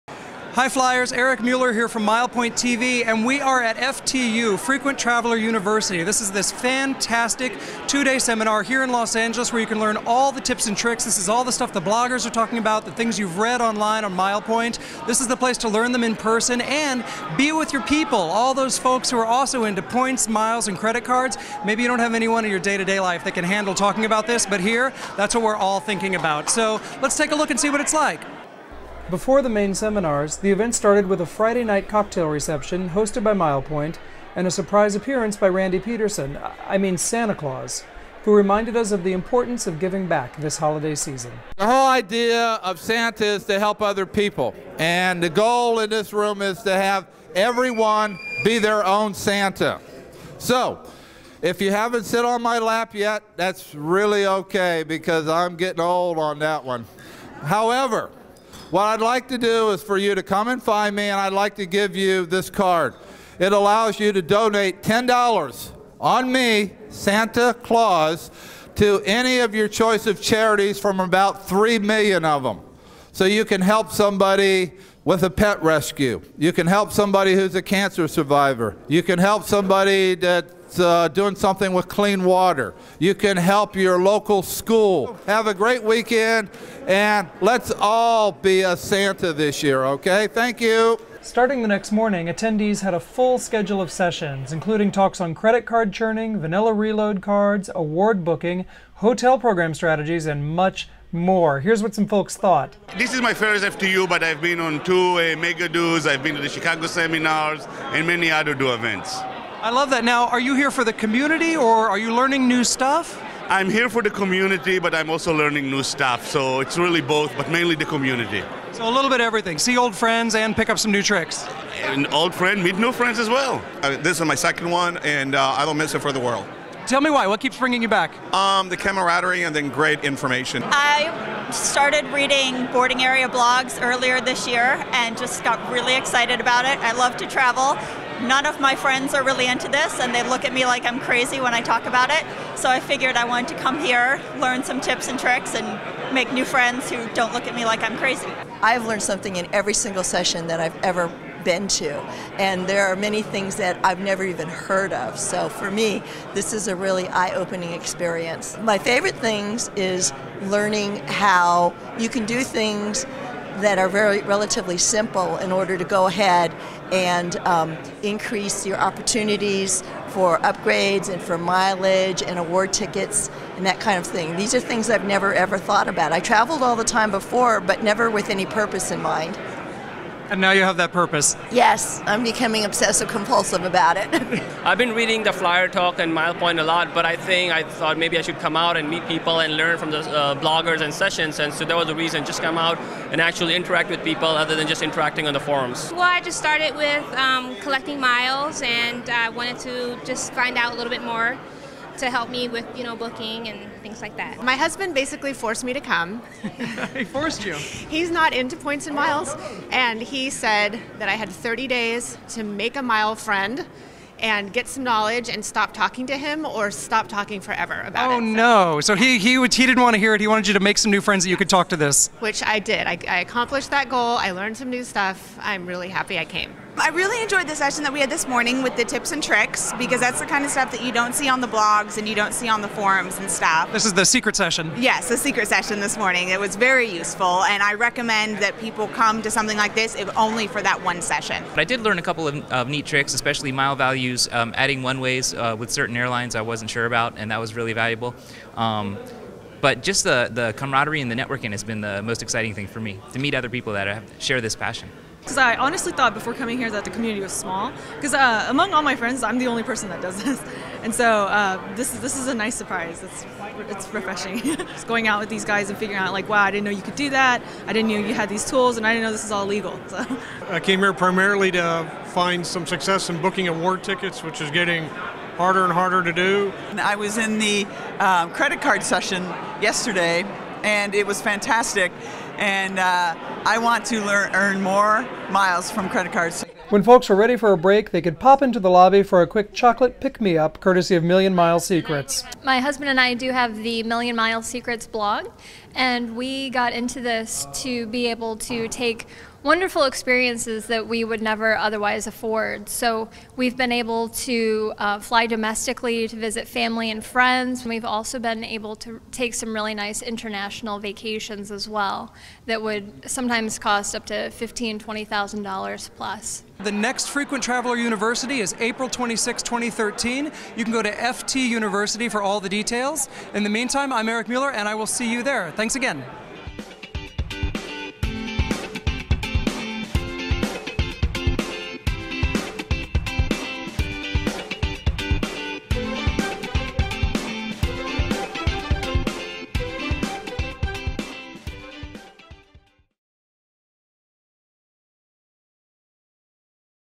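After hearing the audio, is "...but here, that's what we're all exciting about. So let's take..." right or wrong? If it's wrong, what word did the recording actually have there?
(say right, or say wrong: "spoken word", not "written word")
wrong: "thinking", not "exciting".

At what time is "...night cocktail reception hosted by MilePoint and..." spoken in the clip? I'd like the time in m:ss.
0:31.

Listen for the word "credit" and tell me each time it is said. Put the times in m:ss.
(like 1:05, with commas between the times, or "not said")
0:20, 1:35, 4:38, 4:45.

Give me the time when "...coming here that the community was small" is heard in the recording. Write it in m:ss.
4:16.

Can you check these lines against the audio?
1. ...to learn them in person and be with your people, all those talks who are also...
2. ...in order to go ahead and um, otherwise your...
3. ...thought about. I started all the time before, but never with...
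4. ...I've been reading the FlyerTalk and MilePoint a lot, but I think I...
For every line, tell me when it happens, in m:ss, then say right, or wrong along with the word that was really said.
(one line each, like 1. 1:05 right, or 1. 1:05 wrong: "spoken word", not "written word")
1. 0:15 wrong: "folks", not "talks"
2. 2:45 wrong: "increase", not "otherwise"
3. 2:55 wrong: "traveled", not "started"
4. 3:04 right.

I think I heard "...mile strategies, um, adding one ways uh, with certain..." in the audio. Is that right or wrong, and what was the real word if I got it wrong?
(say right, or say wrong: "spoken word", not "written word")
wrong: "values", not "strategies".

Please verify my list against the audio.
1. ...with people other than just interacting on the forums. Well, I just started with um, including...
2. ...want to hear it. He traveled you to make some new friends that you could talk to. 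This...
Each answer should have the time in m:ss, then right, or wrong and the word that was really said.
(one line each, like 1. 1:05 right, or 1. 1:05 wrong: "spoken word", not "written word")
1. 3:13 wrong: "collecting", not "including"
2. 3:39 wrong: "wanted", not "traveled".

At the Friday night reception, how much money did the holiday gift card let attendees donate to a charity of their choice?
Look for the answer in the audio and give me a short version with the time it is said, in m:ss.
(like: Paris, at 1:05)
$10, at 1:04.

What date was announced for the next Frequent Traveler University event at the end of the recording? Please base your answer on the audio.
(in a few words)
April 26, 2013.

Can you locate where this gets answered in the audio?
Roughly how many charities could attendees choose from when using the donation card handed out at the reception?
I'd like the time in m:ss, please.
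1:11.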